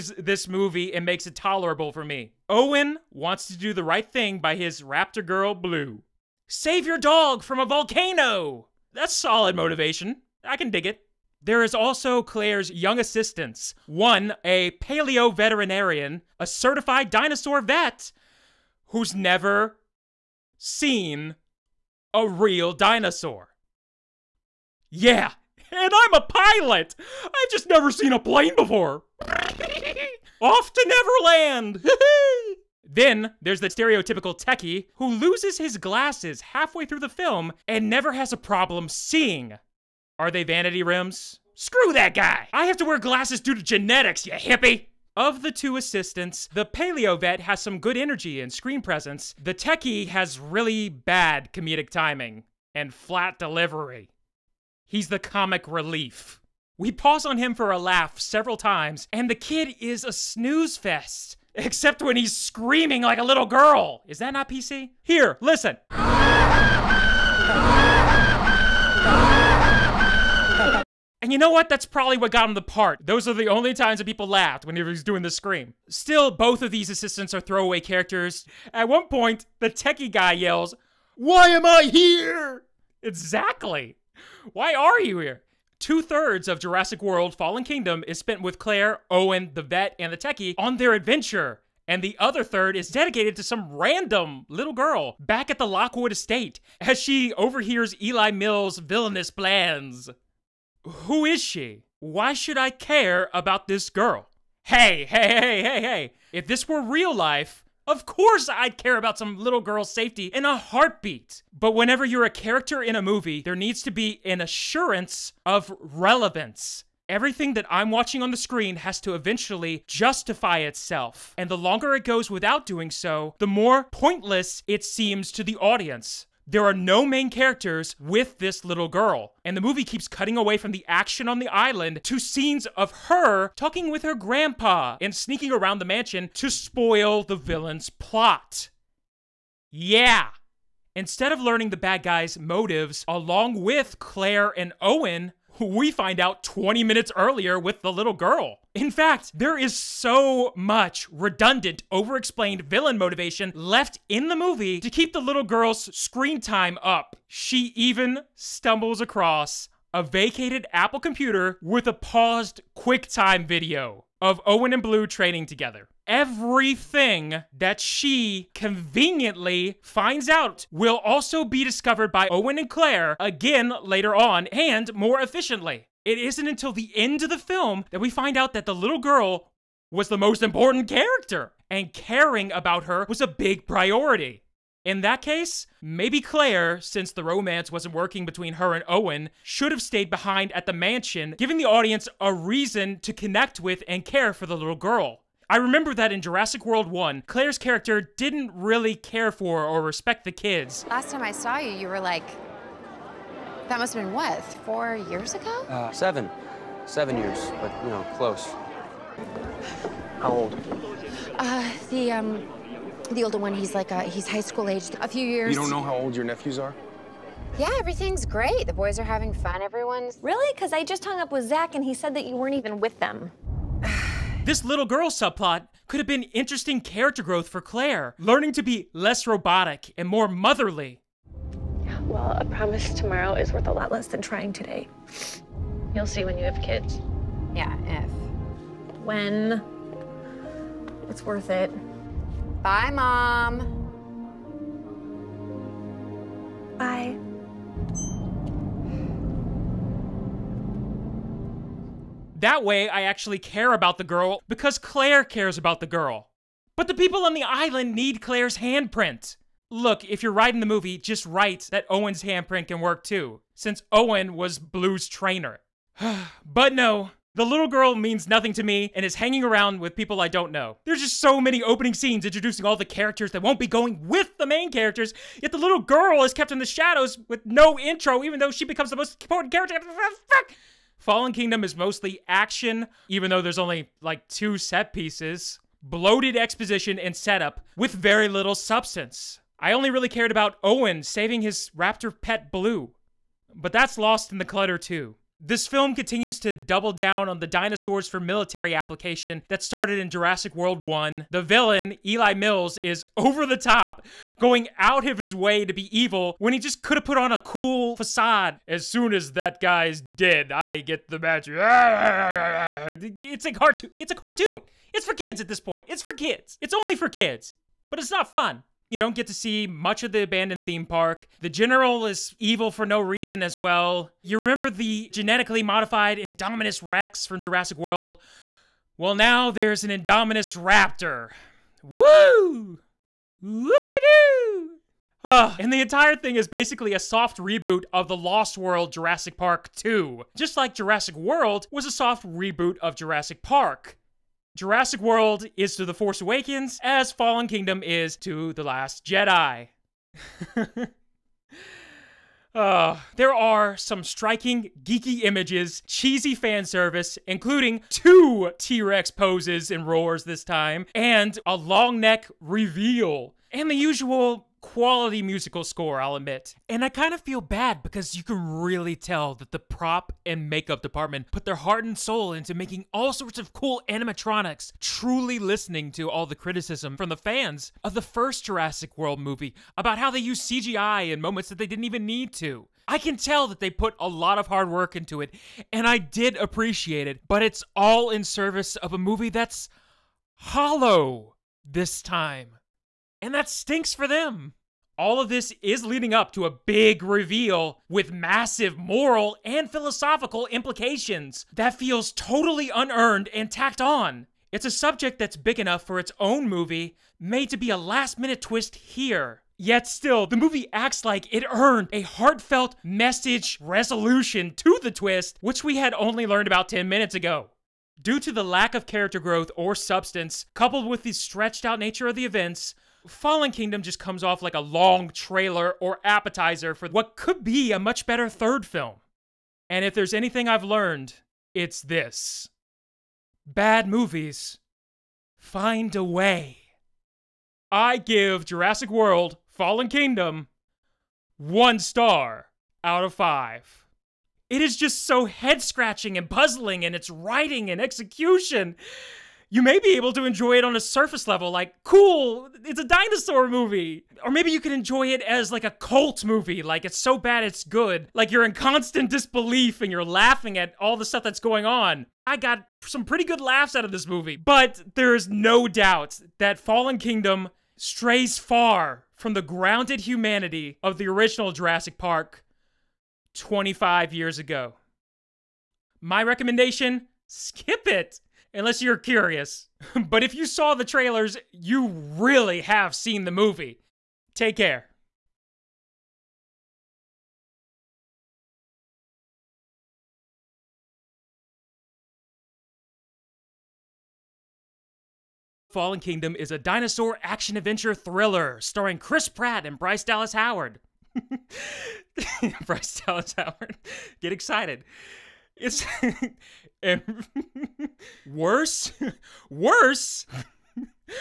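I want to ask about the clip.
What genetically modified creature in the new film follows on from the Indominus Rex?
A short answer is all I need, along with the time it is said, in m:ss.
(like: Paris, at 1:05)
Indominus Raptor, at 5:29.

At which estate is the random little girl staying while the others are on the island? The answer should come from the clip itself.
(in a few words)
Lockwood estate.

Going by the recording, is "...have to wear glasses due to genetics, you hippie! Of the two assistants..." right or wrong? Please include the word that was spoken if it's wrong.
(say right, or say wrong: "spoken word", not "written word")
right.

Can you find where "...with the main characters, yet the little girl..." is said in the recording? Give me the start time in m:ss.
4:34.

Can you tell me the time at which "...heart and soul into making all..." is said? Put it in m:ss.
6:11.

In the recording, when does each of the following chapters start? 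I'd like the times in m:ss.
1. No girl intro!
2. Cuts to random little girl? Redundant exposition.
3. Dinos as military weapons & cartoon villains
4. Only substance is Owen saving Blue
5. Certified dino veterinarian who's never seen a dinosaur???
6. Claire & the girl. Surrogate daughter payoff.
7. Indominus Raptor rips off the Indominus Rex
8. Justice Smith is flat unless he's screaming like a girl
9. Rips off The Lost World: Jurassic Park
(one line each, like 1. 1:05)
1. 4:26
2. 1:25
3. 4:55
4. 4:41
5. 0:11
6. 2:57
7. 5:24
8. 0:32
9. 5:35.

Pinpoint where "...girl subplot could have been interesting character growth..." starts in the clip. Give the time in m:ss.
3:44.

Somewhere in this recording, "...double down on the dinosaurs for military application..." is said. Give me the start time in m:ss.
4:56.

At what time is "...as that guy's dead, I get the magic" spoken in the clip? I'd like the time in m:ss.
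5:09.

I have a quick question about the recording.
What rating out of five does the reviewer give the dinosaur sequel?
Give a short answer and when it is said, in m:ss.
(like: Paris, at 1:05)
1 star, at 7:21.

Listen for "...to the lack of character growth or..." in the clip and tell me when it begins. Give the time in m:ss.
6:58.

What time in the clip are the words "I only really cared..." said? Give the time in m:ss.
4:49.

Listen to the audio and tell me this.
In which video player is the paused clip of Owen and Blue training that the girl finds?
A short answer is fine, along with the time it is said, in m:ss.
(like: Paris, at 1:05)
QuickTime, at 2:42.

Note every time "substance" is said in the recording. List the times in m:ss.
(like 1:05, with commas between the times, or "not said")
4:48, 6:59.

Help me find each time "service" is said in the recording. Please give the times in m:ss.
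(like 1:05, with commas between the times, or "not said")
5:56, 6:28.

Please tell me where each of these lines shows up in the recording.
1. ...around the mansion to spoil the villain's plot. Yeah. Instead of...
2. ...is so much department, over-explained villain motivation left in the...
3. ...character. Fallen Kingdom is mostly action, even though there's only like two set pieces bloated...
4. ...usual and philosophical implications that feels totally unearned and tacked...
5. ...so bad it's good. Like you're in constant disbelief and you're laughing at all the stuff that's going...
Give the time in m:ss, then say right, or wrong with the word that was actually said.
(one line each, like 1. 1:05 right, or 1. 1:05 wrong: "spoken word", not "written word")
1. 2:15 right
2. 2:29 wrong: "redundant", not "department"
3. 4:39 right
4. 6:38 wrong: "moral", not "usual"
5. 7:36 right.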